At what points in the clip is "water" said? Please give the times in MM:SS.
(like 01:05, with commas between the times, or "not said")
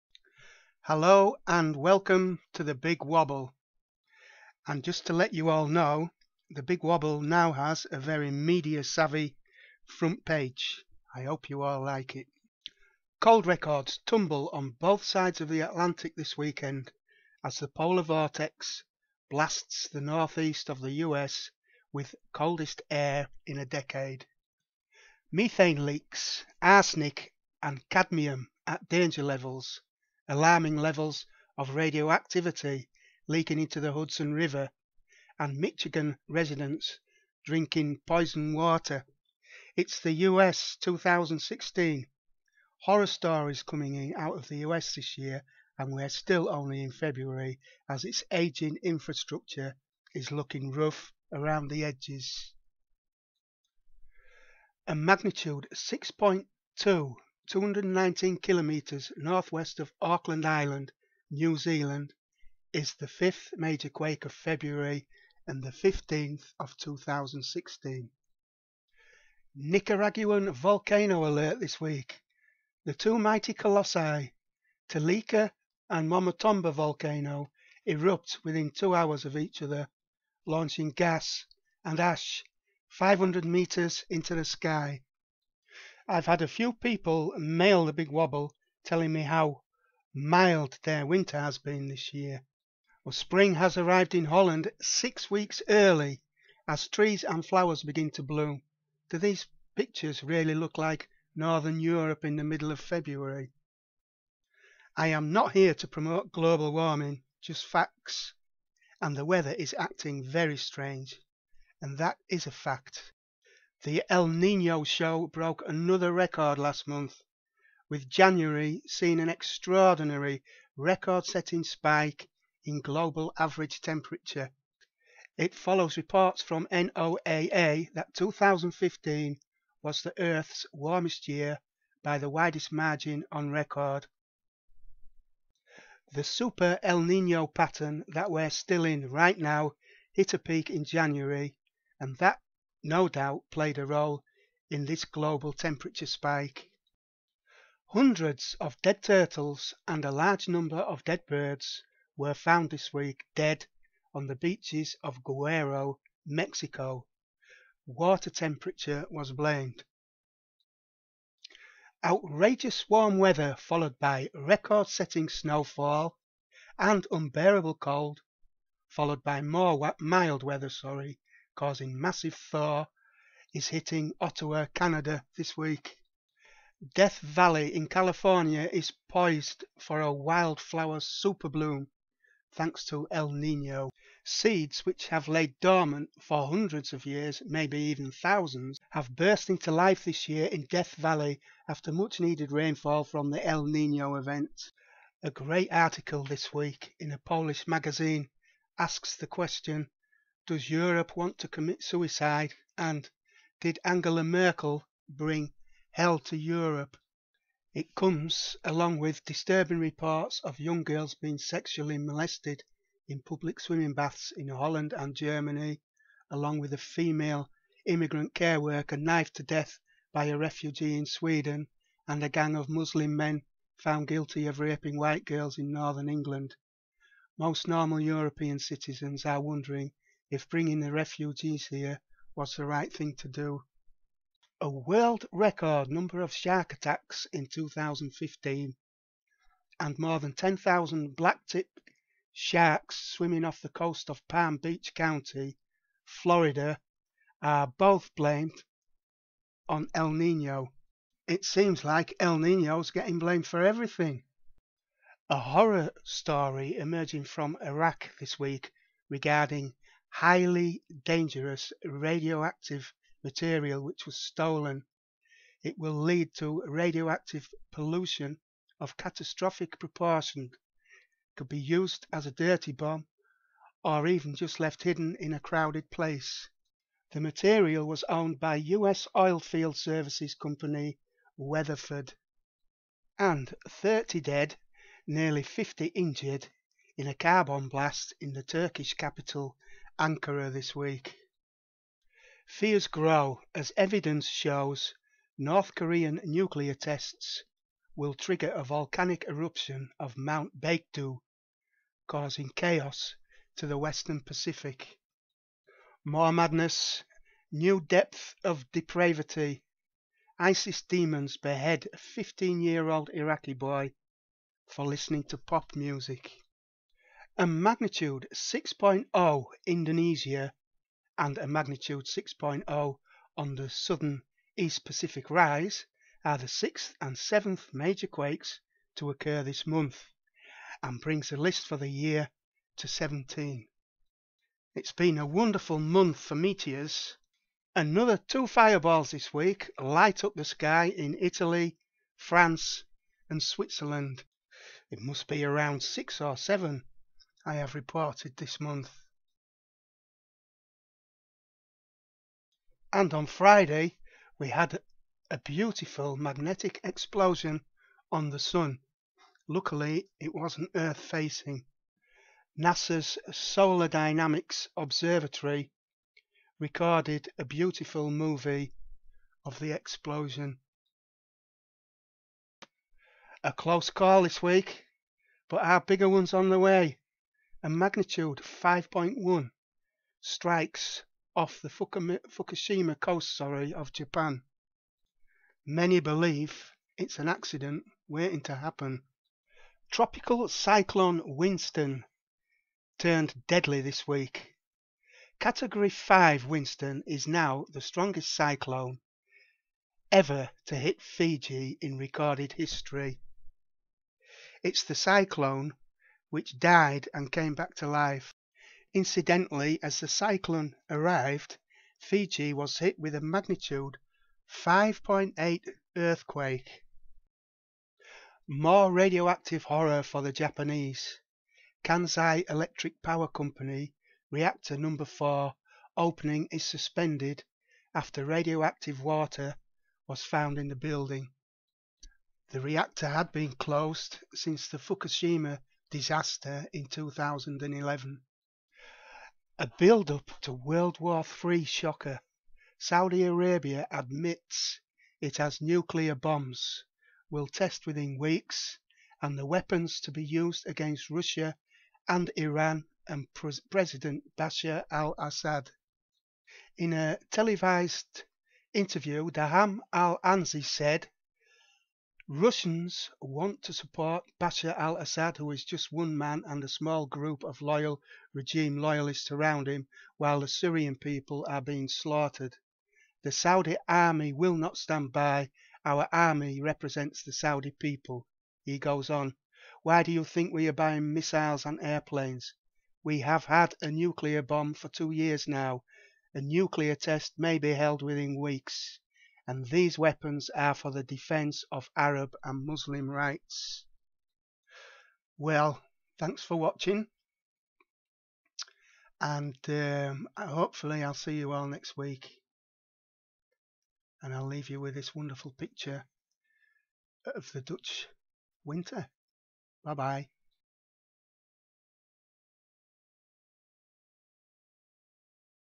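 00:38, 02:37, 07:09.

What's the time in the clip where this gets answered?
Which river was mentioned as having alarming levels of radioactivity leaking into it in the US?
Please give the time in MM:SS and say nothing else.
00:33.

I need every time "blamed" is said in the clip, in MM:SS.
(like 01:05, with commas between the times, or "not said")
02:39, 04:08, 04:13.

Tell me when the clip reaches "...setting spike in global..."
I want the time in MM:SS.
02:01.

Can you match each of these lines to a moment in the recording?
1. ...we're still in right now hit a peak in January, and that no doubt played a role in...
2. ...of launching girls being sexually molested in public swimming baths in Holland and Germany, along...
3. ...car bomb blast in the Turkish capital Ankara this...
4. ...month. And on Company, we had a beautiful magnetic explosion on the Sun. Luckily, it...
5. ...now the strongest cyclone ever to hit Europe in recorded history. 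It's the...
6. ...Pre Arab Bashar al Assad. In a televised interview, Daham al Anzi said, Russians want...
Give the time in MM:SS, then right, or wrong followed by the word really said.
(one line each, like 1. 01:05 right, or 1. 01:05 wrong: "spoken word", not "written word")
1. 02:18 right
2. 03:30 wrong: "young", not "launching"
3. 04:47 right
4. 05:48 wrong: "Friday", not "Company"
5. 06:37 wrong: "Fiji", not "Europe"
6. 07:33 wrong: "President", not "Arab".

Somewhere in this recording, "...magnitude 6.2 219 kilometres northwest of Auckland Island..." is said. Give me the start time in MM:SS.
00:54.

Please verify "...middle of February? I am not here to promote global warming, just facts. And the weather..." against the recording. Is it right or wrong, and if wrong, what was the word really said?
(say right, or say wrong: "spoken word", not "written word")
right.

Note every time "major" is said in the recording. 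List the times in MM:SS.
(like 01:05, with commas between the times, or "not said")
01:03, 05:27.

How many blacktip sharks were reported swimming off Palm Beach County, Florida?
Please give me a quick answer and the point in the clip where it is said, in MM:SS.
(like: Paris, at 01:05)
more than 10,000, at 03:59.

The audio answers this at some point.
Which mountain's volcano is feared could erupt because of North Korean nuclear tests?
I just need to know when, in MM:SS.
05:00.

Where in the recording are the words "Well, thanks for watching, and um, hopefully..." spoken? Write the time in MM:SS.
08:15.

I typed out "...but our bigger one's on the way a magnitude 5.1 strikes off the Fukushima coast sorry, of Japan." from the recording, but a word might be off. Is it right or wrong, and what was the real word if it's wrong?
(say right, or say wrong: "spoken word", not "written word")
right.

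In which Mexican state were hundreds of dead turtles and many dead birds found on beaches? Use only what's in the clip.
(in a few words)
Guerrero.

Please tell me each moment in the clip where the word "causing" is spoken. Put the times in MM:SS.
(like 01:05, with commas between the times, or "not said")
02:51, 05:02.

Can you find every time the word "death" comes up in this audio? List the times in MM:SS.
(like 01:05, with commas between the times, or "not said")
02:56, 03:10, 03:39.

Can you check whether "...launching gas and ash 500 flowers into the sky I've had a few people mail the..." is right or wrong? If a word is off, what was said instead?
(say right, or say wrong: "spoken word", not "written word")
wrong: "meters", not "flowers".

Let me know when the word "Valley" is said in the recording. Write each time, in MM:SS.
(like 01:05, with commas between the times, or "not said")
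02:57, 03:10.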